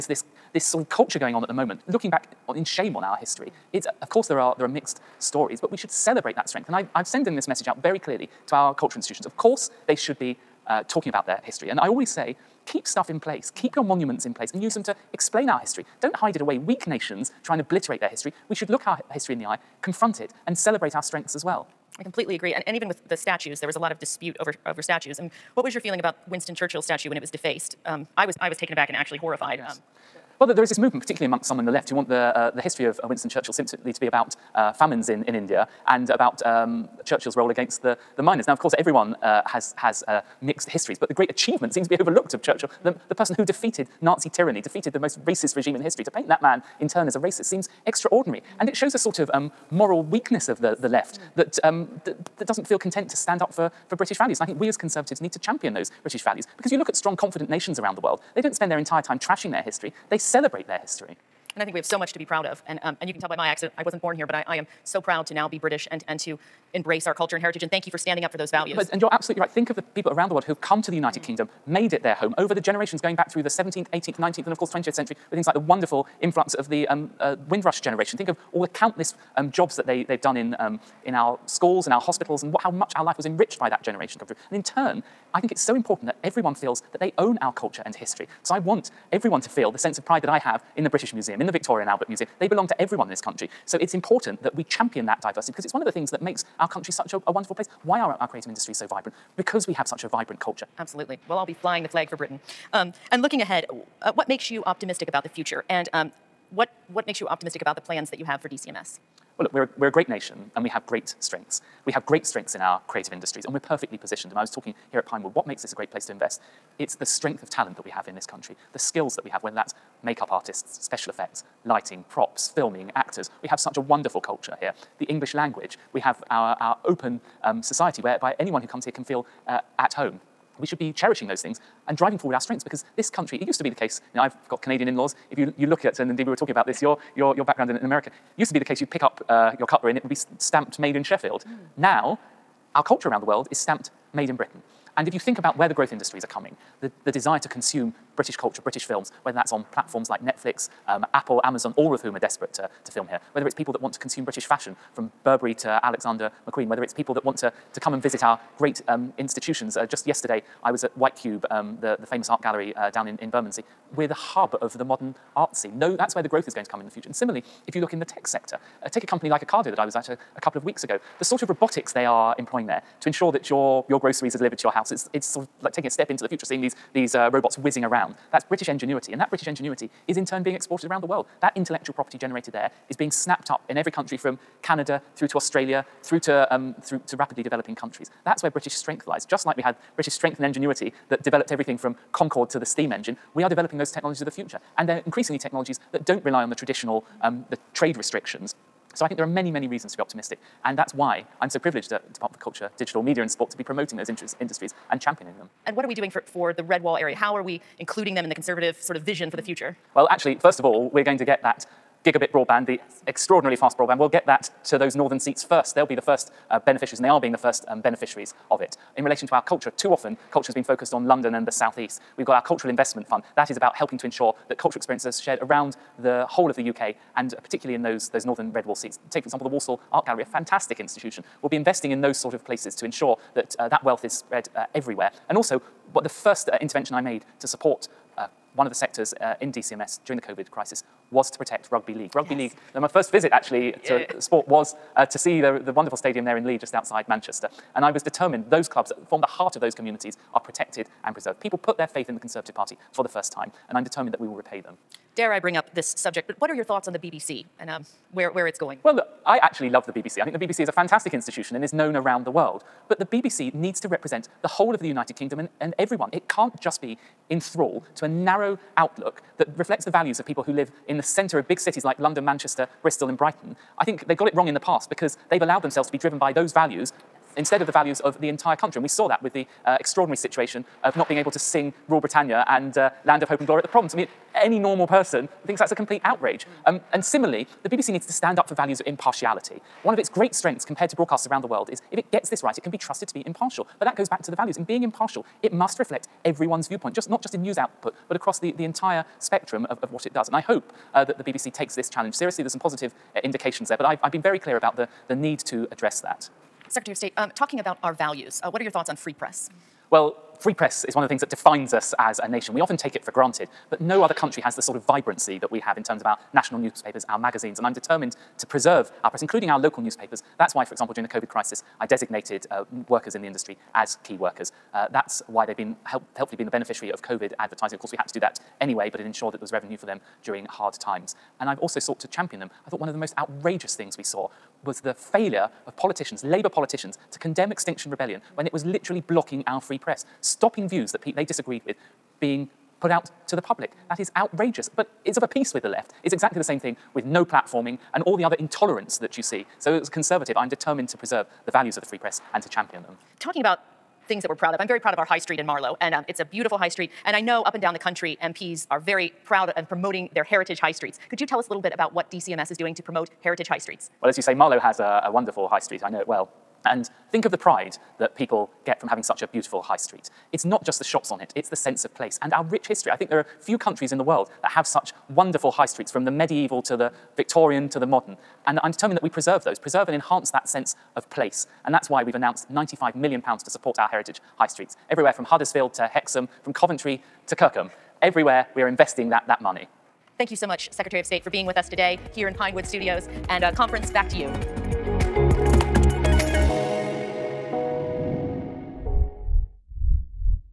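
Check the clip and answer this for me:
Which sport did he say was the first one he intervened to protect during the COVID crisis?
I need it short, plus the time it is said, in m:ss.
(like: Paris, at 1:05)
Rugby league, at 4:01.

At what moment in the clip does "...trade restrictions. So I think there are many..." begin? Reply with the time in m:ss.
3:17.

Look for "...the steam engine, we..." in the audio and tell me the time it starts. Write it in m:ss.
3:12.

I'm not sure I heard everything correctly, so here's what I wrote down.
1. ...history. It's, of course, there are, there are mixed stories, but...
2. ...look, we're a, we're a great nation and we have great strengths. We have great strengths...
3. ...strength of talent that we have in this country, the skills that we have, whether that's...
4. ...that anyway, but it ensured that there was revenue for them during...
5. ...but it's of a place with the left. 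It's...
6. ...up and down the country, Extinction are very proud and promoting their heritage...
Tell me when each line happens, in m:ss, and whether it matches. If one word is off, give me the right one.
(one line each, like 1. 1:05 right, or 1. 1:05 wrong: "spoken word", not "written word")
1. 0:03 right
2. 1:49 right
3. 1:57 right
4. 5:28 right
5. 5:44 wrong: "piece", not "place"
6. 5:57 wrong: "MPs", not "Extinction".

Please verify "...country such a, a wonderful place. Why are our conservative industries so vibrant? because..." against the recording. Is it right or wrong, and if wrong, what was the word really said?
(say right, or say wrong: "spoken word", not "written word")
wrong: "creative", not "conservative".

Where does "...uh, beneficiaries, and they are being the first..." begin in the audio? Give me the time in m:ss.
3:36.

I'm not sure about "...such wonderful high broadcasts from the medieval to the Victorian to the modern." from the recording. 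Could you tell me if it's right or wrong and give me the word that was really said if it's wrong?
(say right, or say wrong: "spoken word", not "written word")
wrong: "streets", not "broadcasts".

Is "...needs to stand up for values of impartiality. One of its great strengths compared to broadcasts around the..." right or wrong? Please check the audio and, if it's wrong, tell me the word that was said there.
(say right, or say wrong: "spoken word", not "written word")
right.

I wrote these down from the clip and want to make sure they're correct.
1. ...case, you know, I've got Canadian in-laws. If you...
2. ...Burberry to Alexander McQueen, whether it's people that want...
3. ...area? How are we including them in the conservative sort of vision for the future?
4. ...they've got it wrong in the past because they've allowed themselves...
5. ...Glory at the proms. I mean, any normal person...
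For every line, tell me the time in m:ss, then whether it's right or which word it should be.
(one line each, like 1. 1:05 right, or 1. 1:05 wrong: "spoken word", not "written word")
1. 2:13 right
2. 2:35 right
3. 3:26 right
4. 4:34 right
5. 4:43 right.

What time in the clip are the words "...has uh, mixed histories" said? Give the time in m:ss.
0:39.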